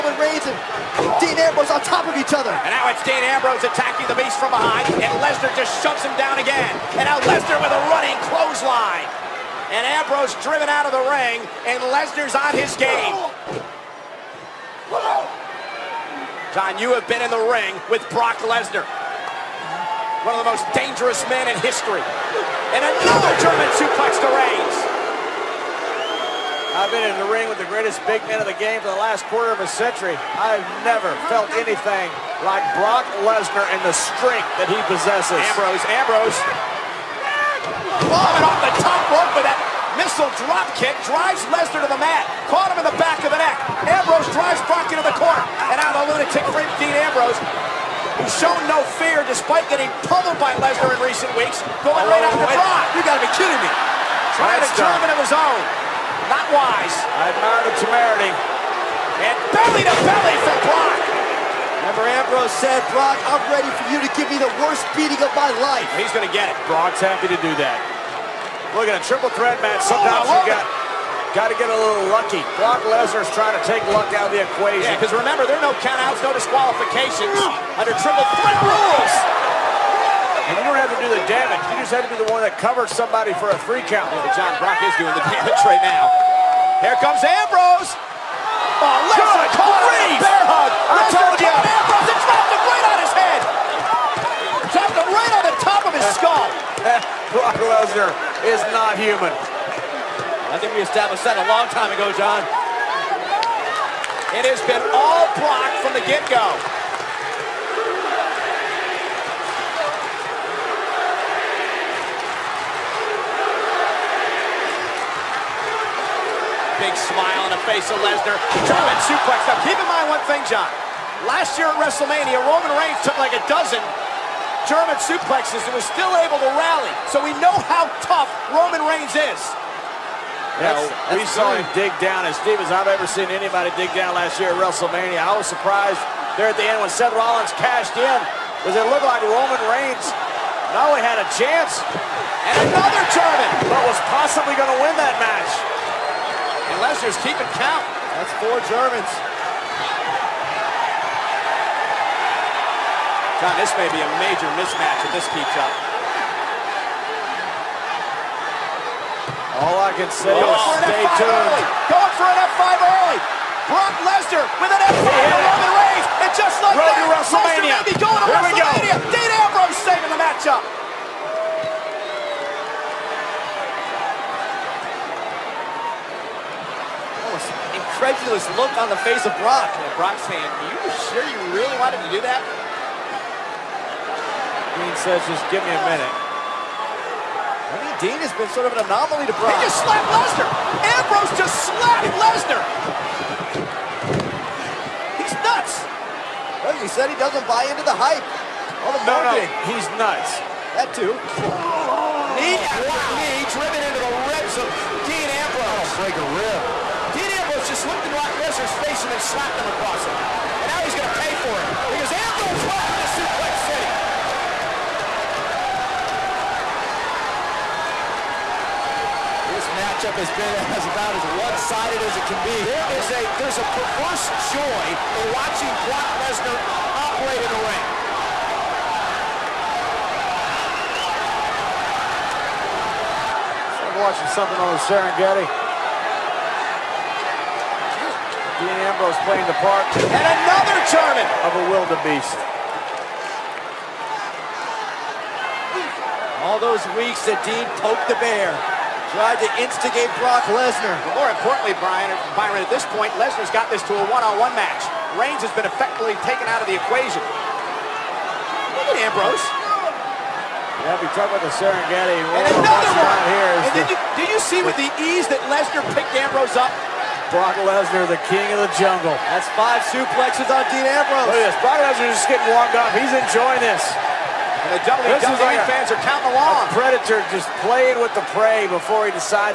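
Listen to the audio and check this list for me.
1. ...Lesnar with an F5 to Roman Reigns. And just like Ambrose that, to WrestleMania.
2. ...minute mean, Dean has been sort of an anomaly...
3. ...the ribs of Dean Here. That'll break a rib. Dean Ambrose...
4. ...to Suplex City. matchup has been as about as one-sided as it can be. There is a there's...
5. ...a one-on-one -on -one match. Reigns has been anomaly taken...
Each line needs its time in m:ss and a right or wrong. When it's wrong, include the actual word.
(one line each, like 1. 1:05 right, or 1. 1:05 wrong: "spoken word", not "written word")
1. 2:44 wrong: "Road", not "Ambrose"
2. 3:05 right
3. 3:23 wrong: "Ambrose", not "Here"
4. 3:33 right
5. 4:13 wrong: "effectively", not "anomaly".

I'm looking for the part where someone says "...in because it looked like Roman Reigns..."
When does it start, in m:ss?
2:17.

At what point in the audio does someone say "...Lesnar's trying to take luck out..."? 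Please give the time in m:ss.
1:12.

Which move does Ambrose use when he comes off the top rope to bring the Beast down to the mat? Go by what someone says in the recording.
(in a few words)
Missile drop kick.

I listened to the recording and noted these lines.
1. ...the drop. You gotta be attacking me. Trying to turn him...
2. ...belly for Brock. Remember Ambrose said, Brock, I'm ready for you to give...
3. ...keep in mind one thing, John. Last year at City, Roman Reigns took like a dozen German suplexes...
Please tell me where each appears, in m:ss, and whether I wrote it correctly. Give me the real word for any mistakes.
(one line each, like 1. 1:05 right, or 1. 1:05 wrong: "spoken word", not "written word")
1. 0:52 wrong: "kidding", not "attacking"
2. 1:00 right
3. 1:59 wrong: "WrestleMania", not "City".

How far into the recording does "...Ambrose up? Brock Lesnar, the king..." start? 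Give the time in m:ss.
4:26.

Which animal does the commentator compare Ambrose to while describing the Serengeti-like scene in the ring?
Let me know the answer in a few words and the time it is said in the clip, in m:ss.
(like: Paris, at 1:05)
Wildebeest, at 4:01.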